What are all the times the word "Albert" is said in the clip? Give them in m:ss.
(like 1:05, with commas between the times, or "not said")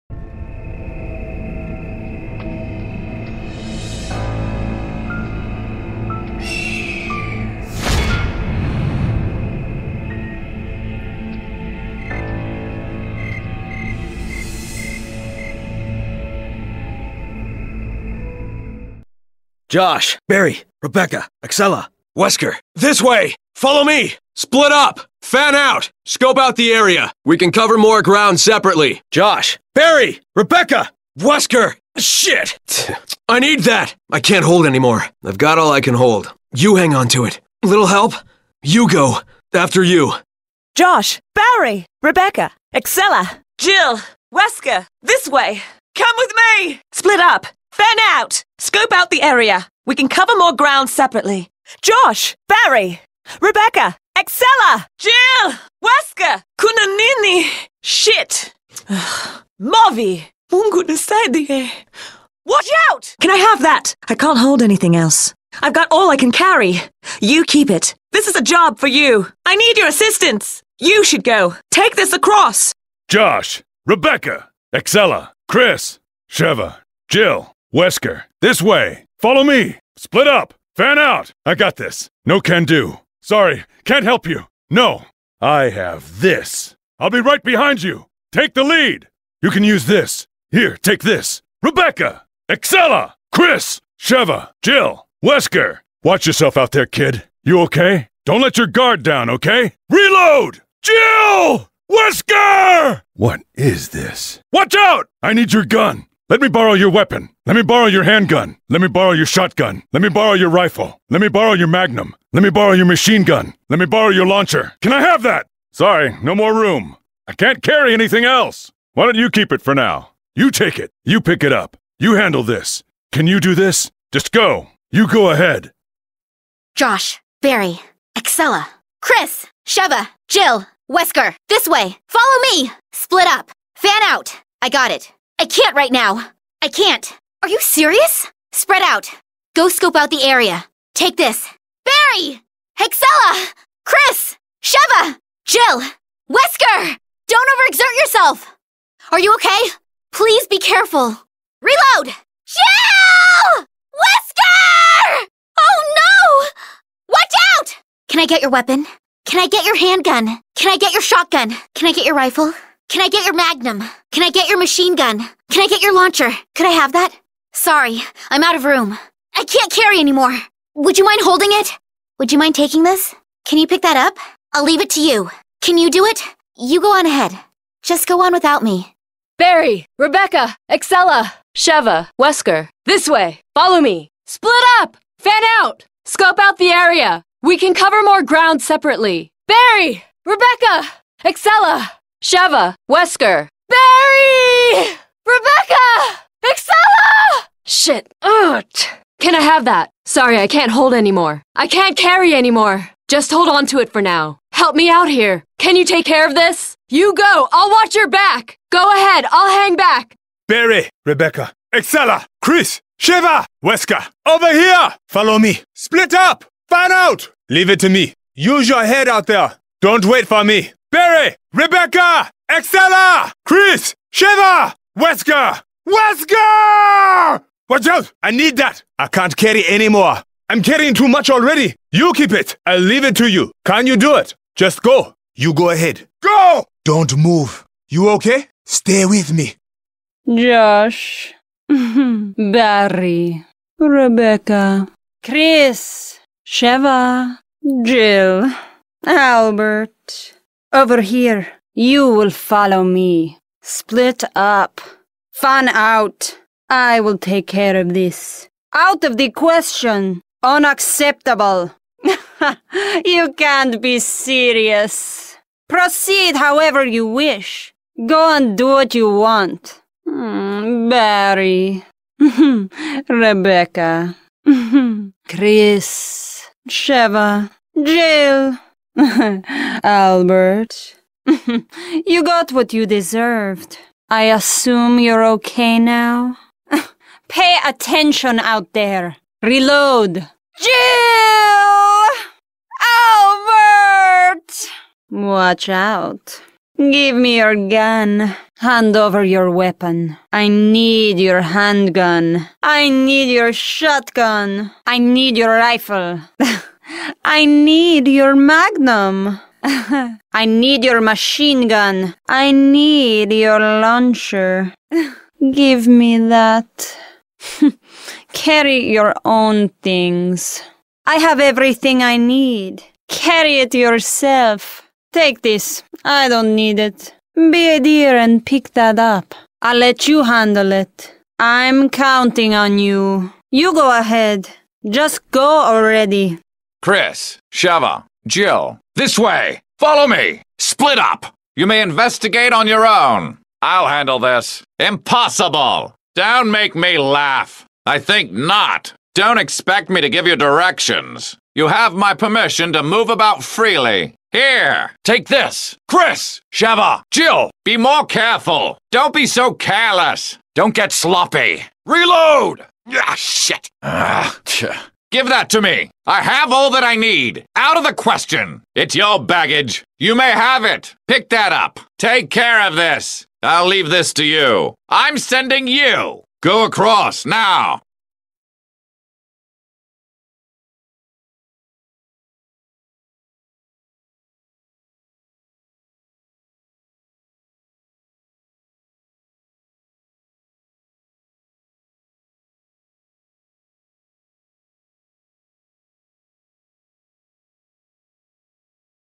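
4:09, 4:38, 4:52.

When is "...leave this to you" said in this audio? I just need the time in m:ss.
6:13.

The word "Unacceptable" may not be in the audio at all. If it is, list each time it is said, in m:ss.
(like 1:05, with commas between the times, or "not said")
4:20.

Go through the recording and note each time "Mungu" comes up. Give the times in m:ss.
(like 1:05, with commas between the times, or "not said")
1:00.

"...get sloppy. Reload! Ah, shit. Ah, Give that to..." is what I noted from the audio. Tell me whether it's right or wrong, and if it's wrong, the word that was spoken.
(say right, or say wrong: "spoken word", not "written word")
right.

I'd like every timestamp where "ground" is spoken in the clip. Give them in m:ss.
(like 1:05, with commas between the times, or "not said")
0:28, 0:50, 3:08.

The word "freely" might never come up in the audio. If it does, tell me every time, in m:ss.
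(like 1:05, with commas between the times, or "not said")
5:53.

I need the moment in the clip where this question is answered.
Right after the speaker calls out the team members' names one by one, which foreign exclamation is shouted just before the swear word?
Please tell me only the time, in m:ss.
0:56.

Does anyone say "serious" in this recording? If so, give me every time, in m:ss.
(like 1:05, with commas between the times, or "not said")
2:17, 4:23.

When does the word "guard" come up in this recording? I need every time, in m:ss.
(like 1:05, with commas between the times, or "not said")
1:38.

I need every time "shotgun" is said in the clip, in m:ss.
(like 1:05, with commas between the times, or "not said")
1:49, 2:41, 5:03.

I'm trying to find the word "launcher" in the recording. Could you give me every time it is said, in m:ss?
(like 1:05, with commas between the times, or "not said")
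1:54, 2:45, 5:13.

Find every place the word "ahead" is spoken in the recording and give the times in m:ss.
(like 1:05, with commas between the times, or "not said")
2:05, 2:57, 3:28, 3:55, 5:33.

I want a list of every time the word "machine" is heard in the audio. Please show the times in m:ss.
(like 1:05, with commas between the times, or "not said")
1:52, 2:44, 5:11.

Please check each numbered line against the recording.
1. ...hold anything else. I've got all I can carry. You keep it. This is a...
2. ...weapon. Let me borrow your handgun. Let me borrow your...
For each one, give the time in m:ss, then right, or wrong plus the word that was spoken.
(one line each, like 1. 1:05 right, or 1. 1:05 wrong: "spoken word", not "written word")
1. 1:04 right
2. 1:46 right.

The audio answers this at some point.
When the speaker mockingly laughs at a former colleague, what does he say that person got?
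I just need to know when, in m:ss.
4:42.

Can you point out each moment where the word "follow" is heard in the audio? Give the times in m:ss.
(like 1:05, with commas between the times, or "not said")
0:23, 1:19, 2:12, 3:03, 3:35, 4:12, 5:39.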